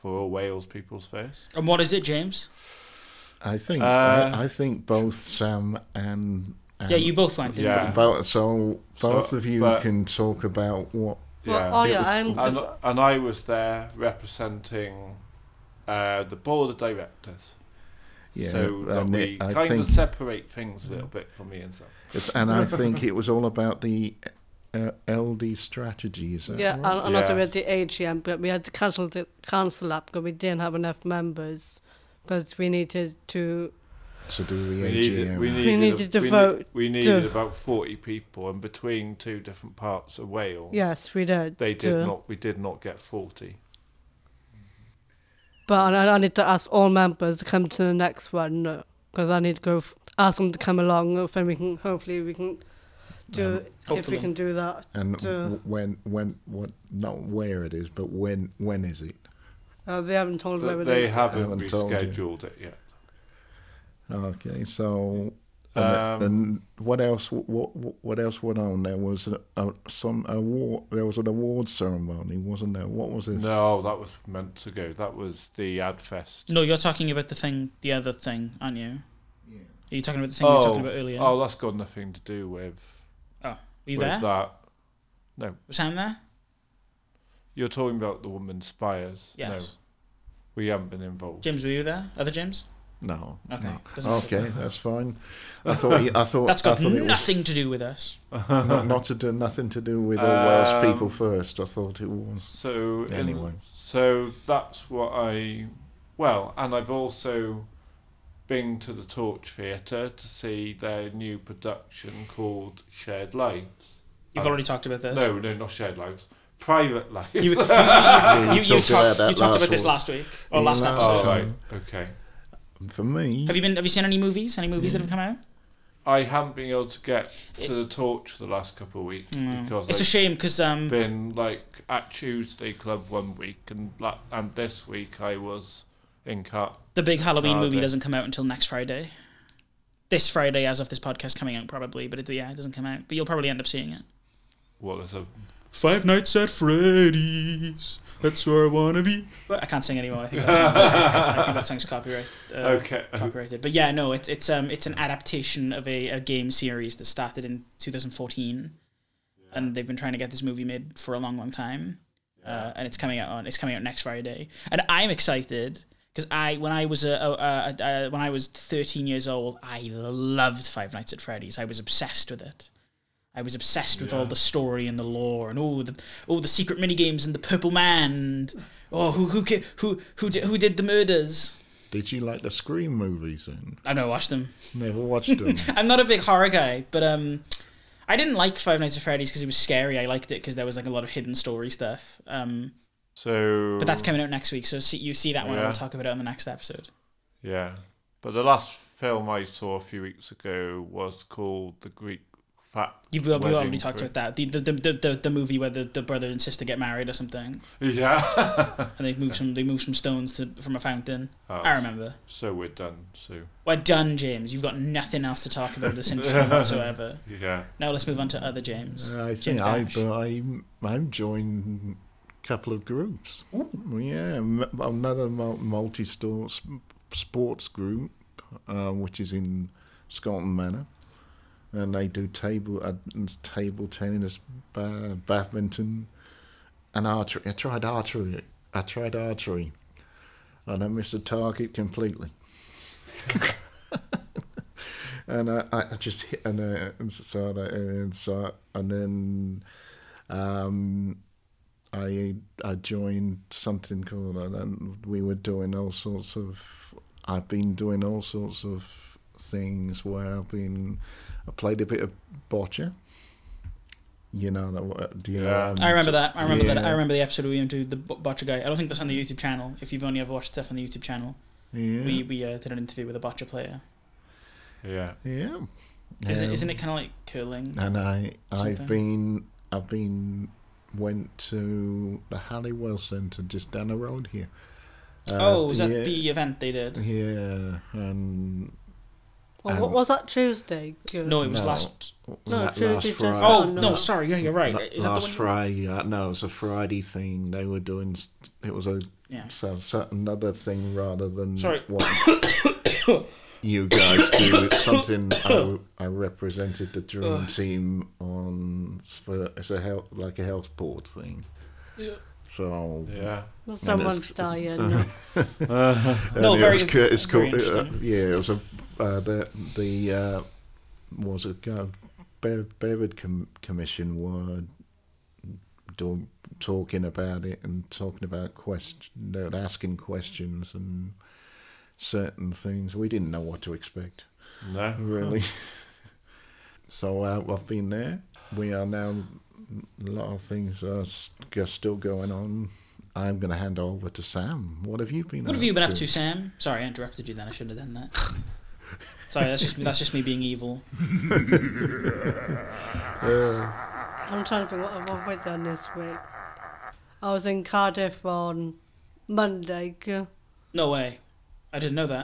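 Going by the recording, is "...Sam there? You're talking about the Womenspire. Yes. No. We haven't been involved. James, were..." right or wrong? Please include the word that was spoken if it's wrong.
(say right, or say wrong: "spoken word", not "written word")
right.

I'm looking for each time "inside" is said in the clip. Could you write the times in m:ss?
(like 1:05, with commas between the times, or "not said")
4:06.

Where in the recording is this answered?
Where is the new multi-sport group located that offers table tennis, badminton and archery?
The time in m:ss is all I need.
3:50.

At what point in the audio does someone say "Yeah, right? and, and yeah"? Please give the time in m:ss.
0:26.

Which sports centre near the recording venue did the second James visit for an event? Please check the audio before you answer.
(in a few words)
Halliwell Centre.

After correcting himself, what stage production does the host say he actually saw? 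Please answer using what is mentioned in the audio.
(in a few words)
Private Lives.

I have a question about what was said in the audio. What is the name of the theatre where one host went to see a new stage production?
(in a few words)
Torch Theatre.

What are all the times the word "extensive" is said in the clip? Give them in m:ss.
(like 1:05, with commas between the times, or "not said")
not said.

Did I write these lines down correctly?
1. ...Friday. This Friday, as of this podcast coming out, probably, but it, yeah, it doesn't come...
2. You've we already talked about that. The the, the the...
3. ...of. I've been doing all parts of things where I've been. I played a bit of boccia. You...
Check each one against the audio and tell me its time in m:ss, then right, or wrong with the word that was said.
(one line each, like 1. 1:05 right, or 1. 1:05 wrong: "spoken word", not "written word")
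1. 2:18 right
2. 3:23 right
3. 4:16 wrong: "sorts", not "parts".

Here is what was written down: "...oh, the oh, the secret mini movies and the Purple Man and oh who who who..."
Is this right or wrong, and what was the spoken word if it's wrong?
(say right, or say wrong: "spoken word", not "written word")
wrong: "games", not "movies".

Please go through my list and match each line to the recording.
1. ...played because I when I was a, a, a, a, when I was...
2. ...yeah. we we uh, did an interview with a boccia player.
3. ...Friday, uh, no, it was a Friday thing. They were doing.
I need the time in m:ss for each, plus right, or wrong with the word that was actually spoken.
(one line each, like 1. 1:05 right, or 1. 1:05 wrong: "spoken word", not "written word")
1. 2:45 wrong: "excited", not "played"
2. 4:31 right
3. 4:55 right.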